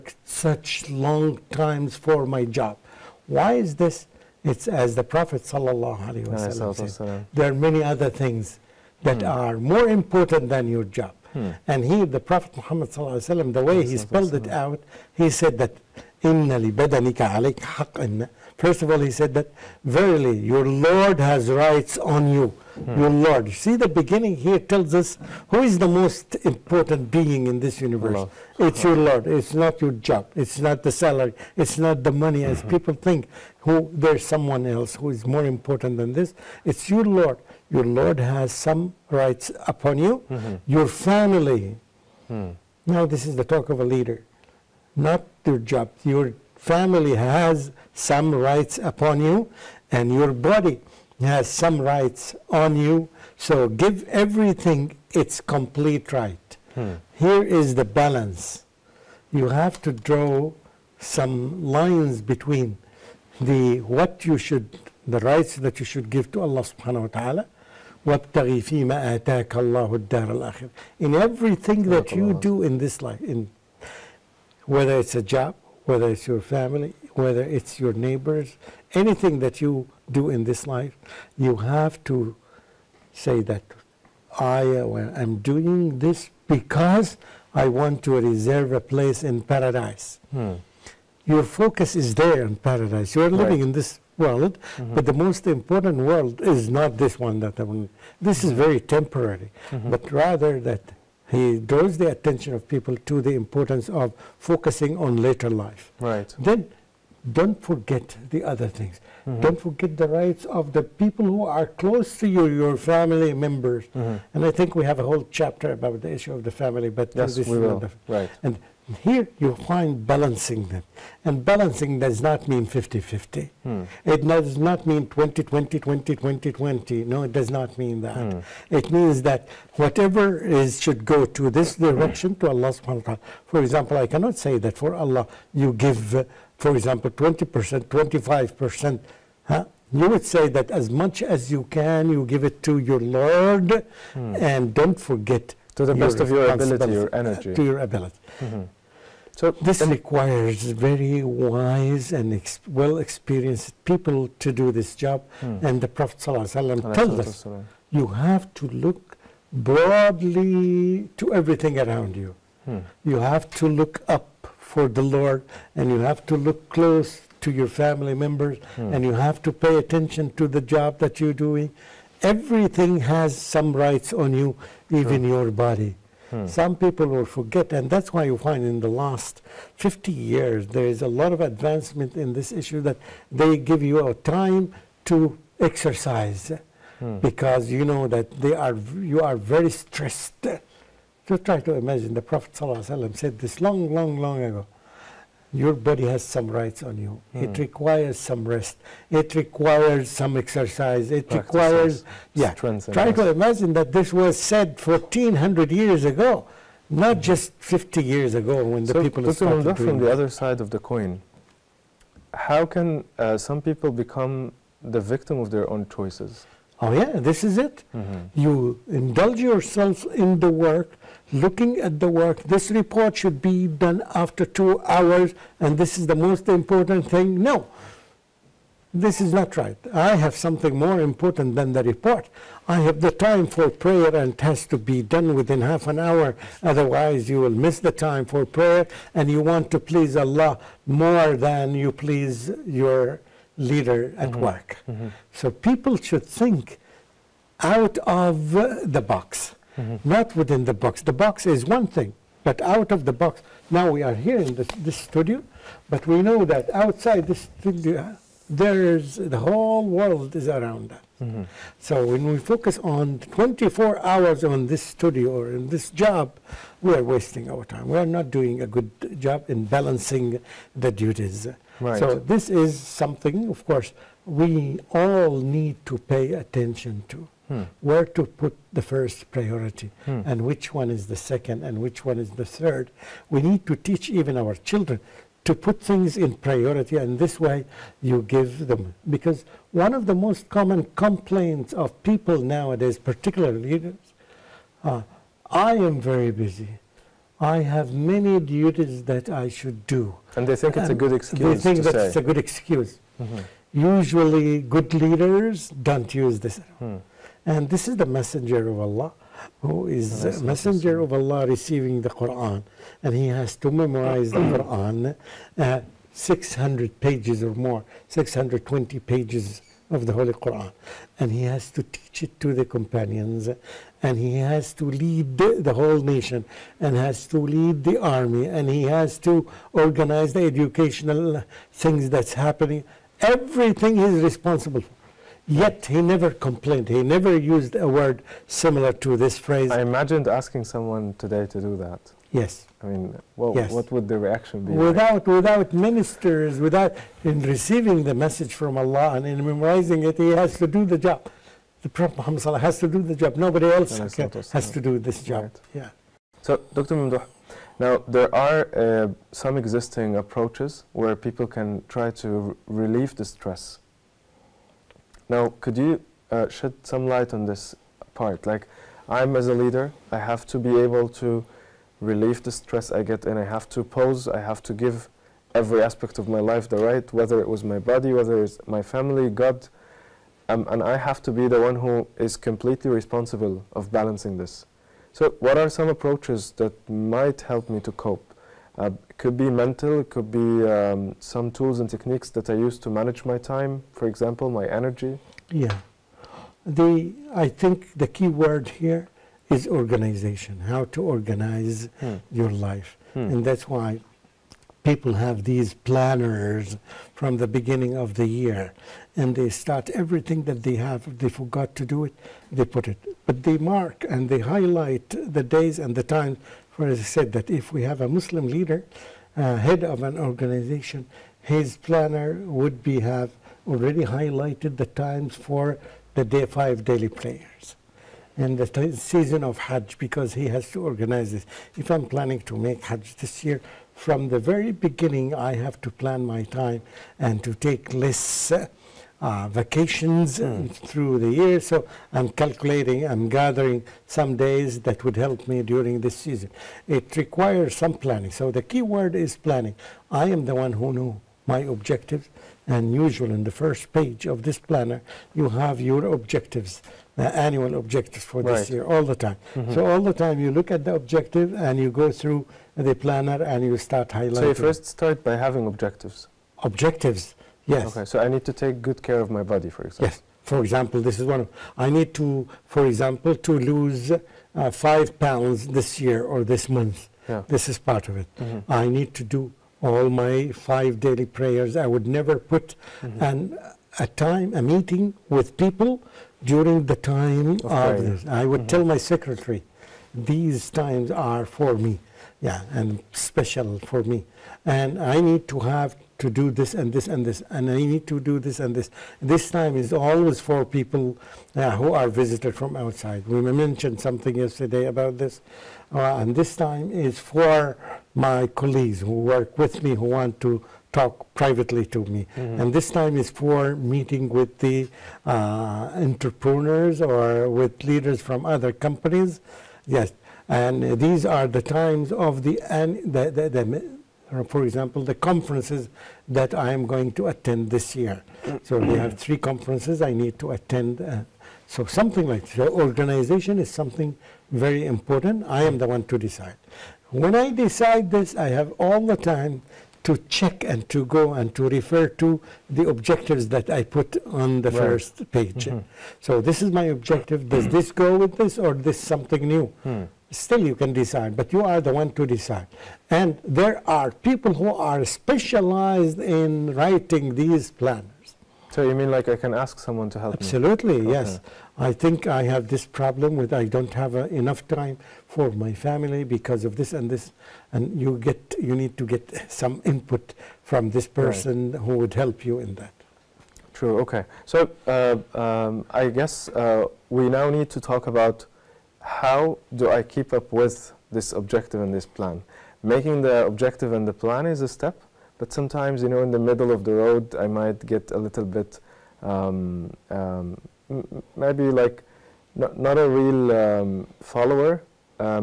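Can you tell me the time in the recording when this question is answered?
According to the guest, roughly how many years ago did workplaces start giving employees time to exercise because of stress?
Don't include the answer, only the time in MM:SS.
02:58.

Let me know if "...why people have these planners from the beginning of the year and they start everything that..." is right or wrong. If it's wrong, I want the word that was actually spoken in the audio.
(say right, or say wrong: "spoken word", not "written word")
right.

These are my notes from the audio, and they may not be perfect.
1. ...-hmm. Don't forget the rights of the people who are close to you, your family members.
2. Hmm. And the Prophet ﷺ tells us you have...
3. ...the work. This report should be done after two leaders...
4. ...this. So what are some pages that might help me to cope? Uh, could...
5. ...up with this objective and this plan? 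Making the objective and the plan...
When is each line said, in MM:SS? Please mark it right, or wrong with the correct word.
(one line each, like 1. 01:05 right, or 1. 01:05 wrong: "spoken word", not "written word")
1. 01:49 right
2. 02:35 right
3. 03:41 wrong: "hours", not "leaders"
4. 06:24 wrong: "approaches", not "pages"
5. 09:40 right.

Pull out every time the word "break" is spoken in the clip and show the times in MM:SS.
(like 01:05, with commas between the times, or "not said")
not said.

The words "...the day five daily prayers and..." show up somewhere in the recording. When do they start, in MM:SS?
07:06.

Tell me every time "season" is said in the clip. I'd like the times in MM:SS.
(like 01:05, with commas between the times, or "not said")
07:08, 07:26.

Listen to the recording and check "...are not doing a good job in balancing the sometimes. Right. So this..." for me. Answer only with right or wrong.
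wrong.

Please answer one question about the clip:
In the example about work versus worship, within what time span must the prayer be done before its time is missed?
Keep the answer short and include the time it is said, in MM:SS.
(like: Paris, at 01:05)
Half an hour, at 03:55.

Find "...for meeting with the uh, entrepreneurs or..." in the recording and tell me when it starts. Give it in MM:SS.
08:33.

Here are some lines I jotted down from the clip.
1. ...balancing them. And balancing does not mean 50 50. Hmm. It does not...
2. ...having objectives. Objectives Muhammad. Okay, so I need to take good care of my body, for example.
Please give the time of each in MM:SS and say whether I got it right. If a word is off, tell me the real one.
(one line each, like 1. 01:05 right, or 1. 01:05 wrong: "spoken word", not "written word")
1. 02:00 right
2. 07:45 wrong: "Yes", not "Muhammad".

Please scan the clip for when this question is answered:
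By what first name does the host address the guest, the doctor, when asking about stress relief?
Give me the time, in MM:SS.
05:56.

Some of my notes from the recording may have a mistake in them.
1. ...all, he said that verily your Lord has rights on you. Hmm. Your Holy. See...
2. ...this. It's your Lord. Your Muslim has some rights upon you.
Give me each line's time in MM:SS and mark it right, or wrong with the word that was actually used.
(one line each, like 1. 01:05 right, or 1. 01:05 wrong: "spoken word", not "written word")
1. 00:18 wrong: "Lord", not "Holy"
2. 00:36 wrong: "Lord", not "Muslim".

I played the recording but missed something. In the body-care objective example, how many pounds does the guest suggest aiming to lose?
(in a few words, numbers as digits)
5.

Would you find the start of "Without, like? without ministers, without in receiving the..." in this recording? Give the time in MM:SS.
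05:44.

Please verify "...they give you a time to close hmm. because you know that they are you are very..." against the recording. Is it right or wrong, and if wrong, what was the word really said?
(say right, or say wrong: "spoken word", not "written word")
wrong: "exercise", not "close".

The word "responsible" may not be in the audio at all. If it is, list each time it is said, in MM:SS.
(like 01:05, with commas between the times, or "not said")
05:34, 06:22.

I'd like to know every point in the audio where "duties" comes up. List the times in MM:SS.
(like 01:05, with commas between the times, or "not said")
04:30, 04:58.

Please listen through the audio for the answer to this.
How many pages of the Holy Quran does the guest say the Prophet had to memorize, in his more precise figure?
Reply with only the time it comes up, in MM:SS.
05:18.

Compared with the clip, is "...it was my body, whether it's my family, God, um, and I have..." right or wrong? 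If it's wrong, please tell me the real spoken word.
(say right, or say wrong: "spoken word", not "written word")
right.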